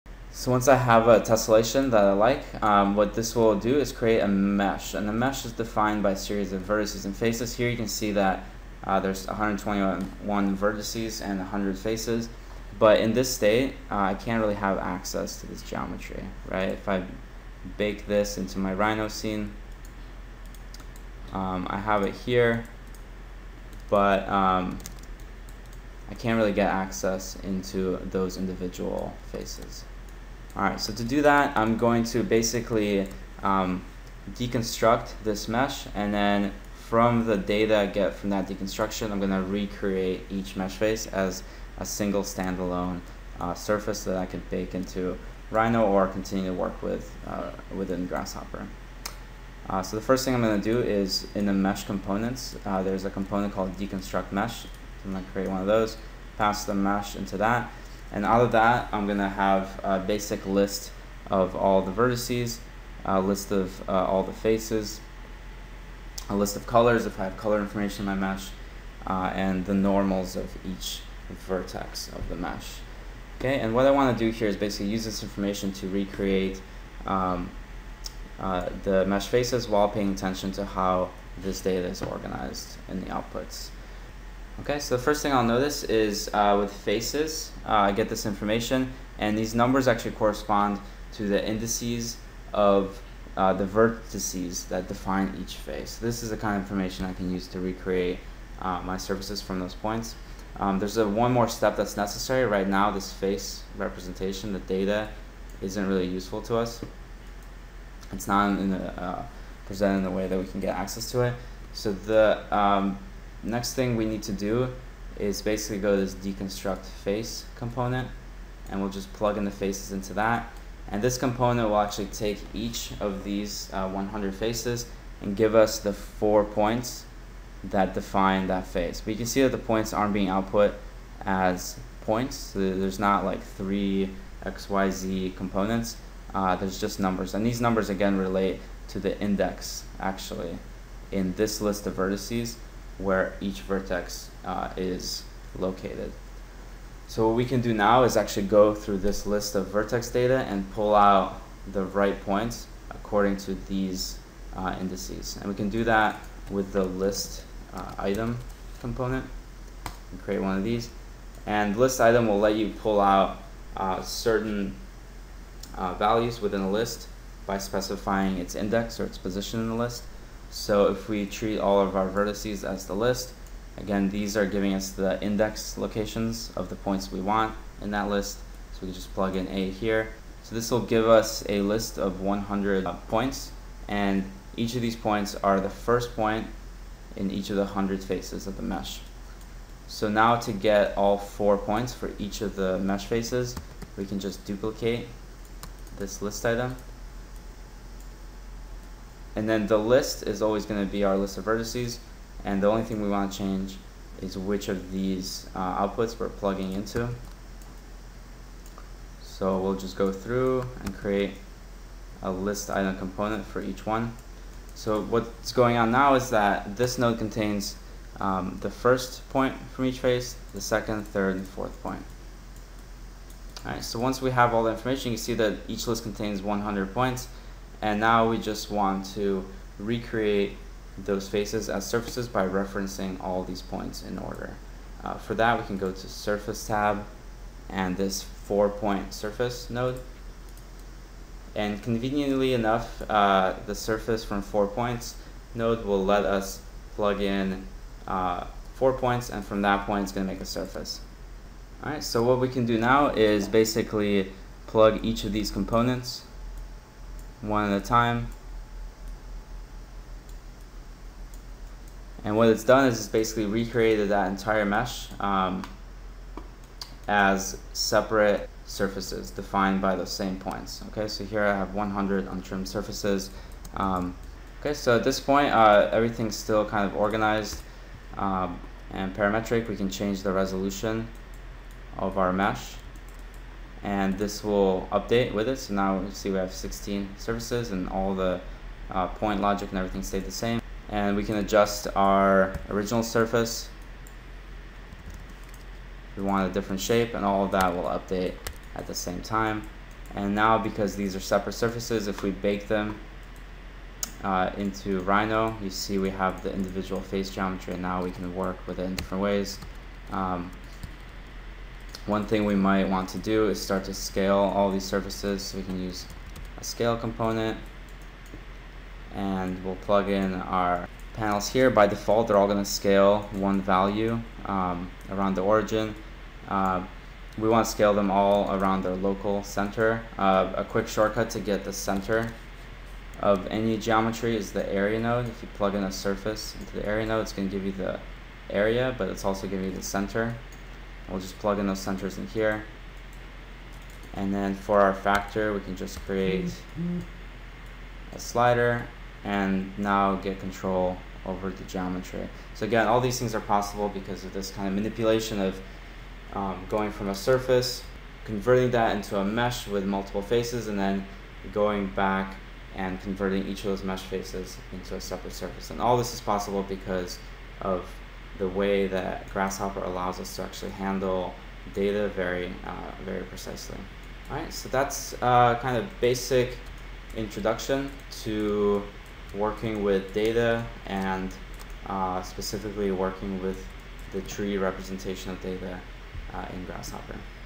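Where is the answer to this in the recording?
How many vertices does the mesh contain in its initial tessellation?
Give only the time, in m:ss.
0:09.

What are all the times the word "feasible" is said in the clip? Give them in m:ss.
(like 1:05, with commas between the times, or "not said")
not said.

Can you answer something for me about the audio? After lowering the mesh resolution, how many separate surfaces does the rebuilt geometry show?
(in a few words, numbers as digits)
16.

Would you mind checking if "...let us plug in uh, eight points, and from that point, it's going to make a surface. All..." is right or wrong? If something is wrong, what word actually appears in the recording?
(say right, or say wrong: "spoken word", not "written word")
wrong: "four", not "eight".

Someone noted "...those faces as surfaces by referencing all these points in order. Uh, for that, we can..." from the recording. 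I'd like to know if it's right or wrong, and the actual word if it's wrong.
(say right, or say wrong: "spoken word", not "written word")
right.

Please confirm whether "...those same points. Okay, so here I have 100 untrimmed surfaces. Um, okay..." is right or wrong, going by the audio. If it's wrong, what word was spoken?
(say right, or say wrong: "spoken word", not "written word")
right.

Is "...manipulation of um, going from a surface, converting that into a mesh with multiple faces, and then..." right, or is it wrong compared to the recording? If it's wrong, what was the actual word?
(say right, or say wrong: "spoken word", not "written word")
right.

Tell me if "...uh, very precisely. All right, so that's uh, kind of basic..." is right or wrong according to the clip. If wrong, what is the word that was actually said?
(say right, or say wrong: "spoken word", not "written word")
right.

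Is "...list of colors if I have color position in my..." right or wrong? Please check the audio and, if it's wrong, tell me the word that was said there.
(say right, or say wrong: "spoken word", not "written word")
wrong: "information", not "position".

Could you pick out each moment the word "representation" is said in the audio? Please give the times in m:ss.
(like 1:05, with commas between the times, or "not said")
1:43, 6:24.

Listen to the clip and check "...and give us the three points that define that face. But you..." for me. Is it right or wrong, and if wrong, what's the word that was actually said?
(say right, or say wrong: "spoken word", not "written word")
wrong: "four", not "three".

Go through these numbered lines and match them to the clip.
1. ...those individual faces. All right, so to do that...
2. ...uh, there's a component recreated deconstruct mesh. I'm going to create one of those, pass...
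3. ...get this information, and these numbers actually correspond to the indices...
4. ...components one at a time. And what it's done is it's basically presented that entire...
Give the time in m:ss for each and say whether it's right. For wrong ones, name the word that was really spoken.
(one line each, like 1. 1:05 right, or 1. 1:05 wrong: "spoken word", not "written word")
1. 0:28 right
2. 0:52 wrong: "called", not "recreated"
3. 1:27 right
4. 4:15 wrong: "recreated", not "presented".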